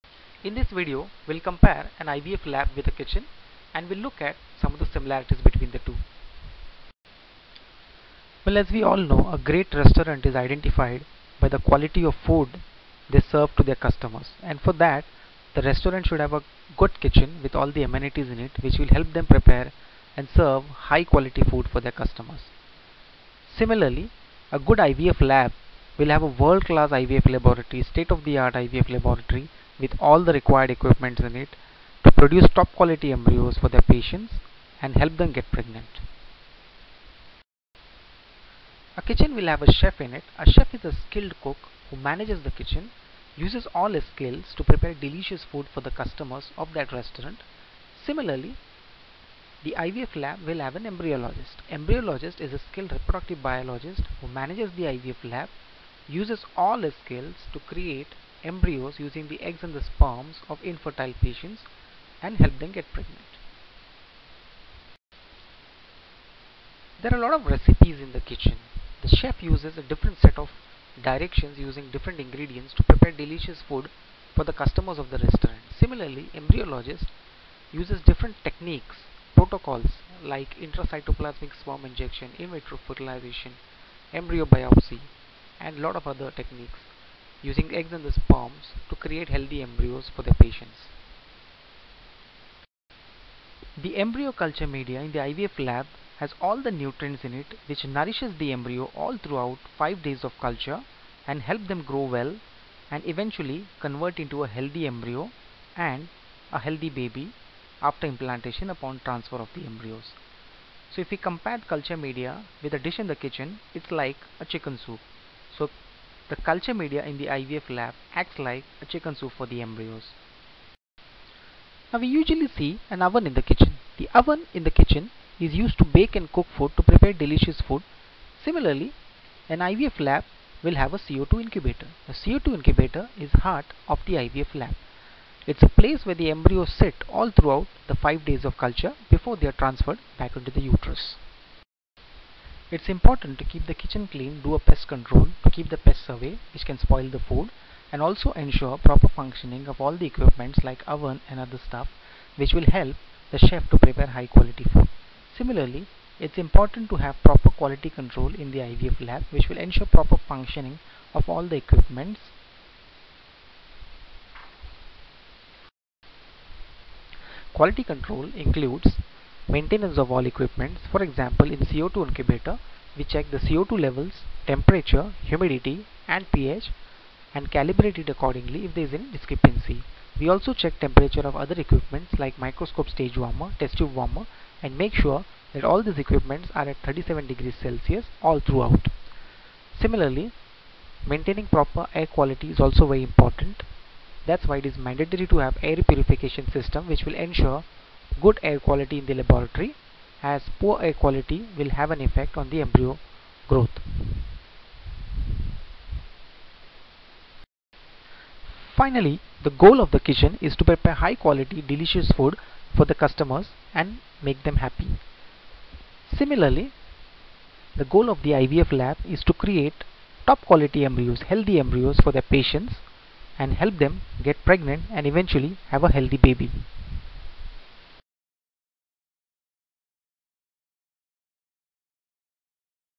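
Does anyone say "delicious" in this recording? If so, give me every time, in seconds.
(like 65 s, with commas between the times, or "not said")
44 s, 73 s, 127 s, 211 s.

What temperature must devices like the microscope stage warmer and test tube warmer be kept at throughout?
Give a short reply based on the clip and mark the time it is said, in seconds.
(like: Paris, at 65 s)
37 degrees Celsius, at 186 s.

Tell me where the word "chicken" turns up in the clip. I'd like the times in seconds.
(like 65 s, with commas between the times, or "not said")
114 s, 118 s.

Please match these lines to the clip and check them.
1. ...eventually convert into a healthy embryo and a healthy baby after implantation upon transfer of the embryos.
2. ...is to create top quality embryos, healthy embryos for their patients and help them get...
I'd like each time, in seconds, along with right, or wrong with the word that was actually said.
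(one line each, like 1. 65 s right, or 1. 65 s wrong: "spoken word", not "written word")
1. 103 s right
2. 219 s right.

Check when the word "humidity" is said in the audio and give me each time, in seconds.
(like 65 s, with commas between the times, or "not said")
175 s.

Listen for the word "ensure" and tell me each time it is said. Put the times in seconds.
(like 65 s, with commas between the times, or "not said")
148 s, 159 s, 197 s.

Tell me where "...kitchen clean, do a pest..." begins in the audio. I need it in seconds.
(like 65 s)
143 s.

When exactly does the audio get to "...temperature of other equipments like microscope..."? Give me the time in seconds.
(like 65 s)
180 s.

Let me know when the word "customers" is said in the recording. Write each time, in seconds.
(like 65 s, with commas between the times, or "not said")
13 s, 21 s, 45 s, 74 s, 212 s.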